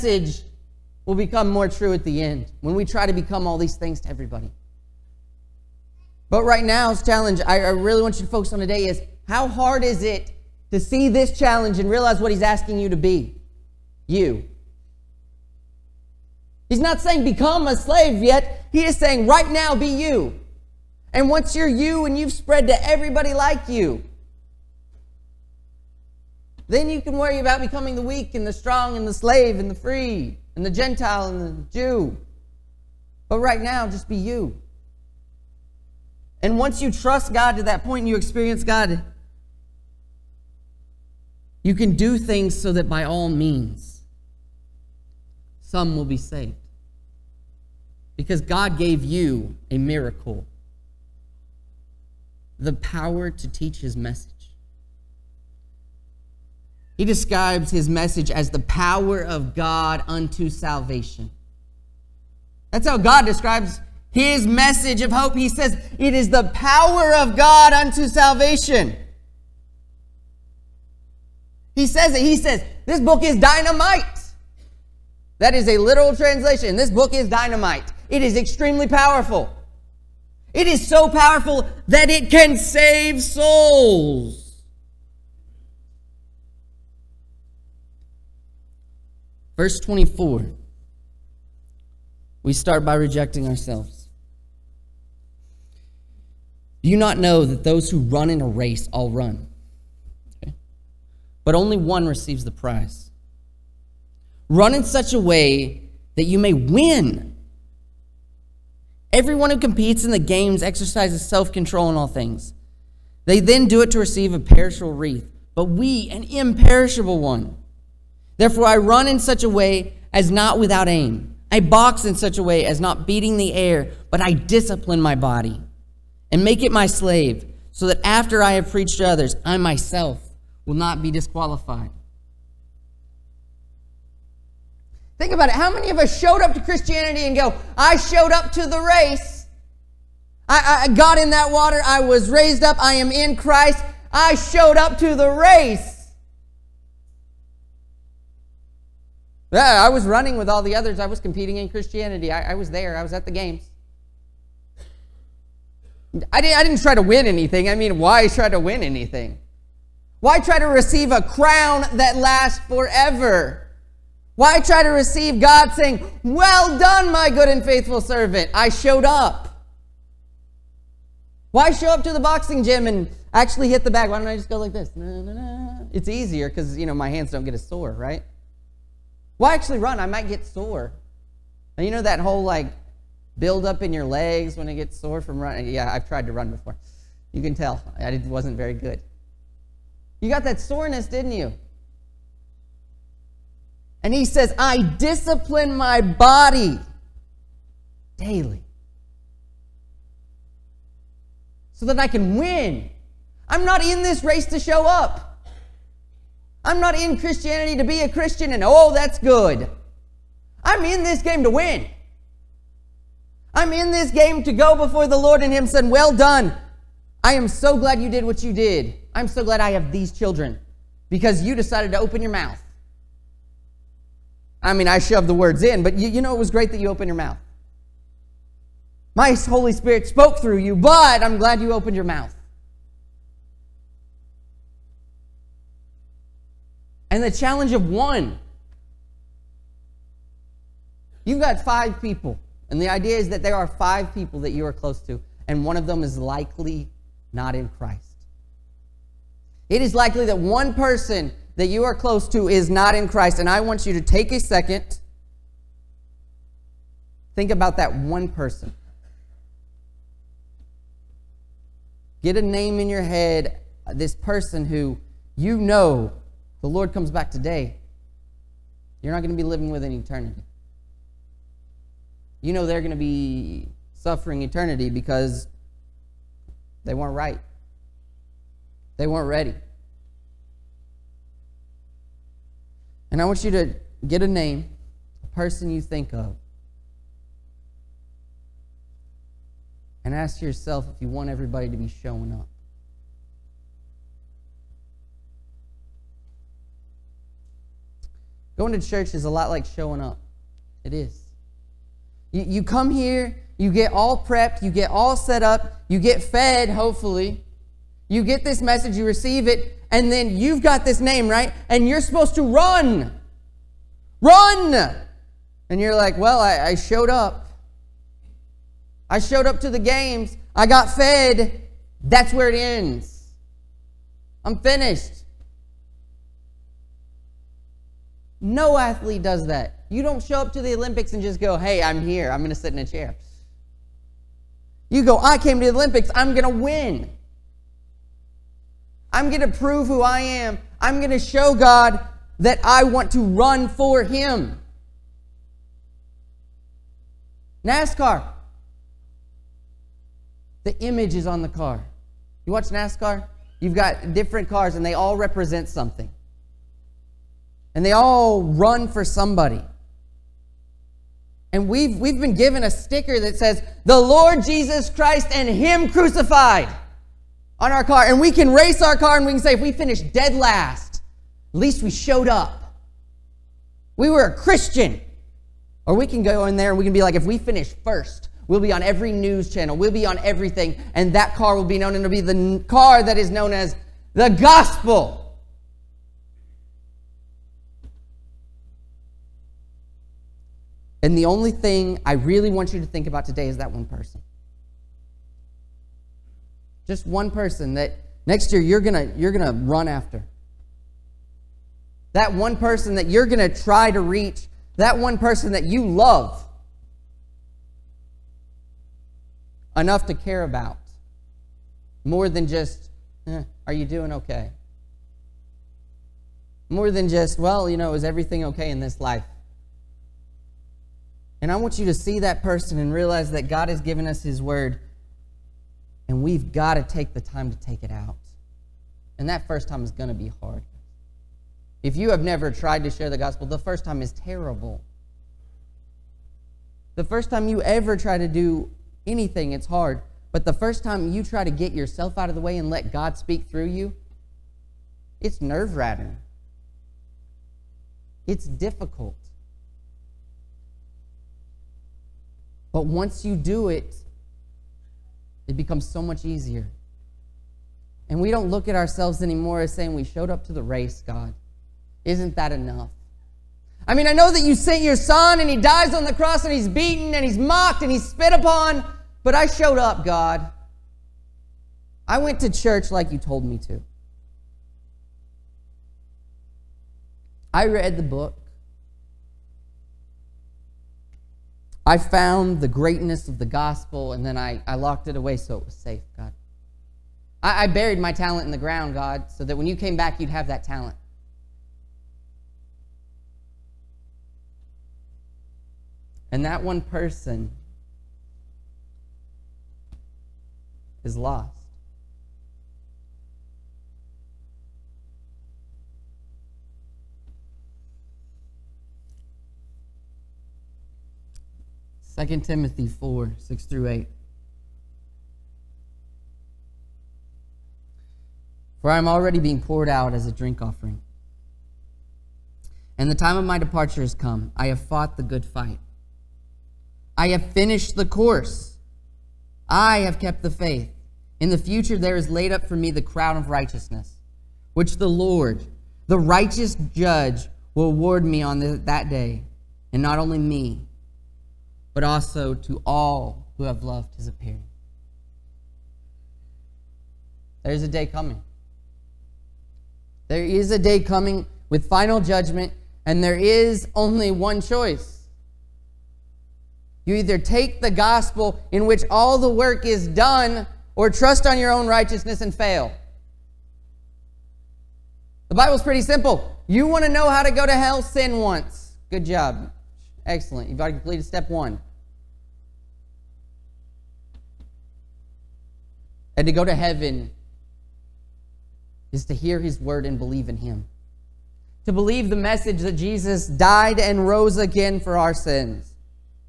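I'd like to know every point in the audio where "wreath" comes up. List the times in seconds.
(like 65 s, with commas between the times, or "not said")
114 s.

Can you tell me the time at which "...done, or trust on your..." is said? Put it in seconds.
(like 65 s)
560 s.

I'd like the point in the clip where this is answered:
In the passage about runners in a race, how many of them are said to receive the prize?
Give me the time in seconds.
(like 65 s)
101 s.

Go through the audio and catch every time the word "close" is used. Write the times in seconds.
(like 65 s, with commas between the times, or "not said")
244 s, 251 s.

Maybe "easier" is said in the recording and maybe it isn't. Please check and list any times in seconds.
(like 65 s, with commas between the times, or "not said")
176 s, 456 s.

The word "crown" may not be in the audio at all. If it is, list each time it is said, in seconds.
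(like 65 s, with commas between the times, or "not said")
161 s, 533 s.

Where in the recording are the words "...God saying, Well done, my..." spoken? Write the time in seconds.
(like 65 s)
165 s.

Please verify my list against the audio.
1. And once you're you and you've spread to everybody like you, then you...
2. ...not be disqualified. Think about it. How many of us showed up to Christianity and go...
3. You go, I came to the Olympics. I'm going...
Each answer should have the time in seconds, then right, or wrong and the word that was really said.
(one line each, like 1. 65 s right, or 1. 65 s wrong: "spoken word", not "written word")
1. 21 s right
2. 130 s right
3. 334 s right.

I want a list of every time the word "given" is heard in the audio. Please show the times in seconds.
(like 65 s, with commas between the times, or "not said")
362 s, 423 s.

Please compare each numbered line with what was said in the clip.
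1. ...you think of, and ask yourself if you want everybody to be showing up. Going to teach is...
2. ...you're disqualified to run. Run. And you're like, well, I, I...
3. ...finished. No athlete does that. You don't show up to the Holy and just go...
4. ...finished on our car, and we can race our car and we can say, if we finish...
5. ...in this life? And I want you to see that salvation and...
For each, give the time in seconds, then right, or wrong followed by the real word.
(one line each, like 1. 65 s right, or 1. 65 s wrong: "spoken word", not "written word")
1. 285 s wrong: "church", not "teach"
2. 311 s wrong: "supposed", not "disqualified"
3. 324 s wrong: "Olympics", not "Holy"
4. 365 s wrong: "crucified", not "finished"
5. 418 s wrong: "person", not "salvation".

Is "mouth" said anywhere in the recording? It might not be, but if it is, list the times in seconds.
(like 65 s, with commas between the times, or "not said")
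222 s, 227 s, 232 s.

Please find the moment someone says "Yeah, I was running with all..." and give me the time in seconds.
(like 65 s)
149 s.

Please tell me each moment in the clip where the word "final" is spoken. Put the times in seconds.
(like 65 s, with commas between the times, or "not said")
551 s.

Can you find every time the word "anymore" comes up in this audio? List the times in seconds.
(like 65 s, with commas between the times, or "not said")
459 s.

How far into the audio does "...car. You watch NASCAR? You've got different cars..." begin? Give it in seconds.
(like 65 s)
351 s.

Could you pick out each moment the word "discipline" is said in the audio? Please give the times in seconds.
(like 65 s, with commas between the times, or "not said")
124 s, 194 s.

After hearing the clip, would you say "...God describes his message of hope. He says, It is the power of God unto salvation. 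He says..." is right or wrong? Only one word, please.
right.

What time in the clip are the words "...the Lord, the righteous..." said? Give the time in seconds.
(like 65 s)
534 s.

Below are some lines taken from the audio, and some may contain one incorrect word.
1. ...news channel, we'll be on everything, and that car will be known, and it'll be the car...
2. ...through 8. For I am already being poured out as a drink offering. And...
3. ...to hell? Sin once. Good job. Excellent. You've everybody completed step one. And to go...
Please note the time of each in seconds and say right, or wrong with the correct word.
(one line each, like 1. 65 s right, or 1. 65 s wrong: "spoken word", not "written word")
1. 379 s right
2. 513 s right
3. 567 s wrong: "already", not "everybody".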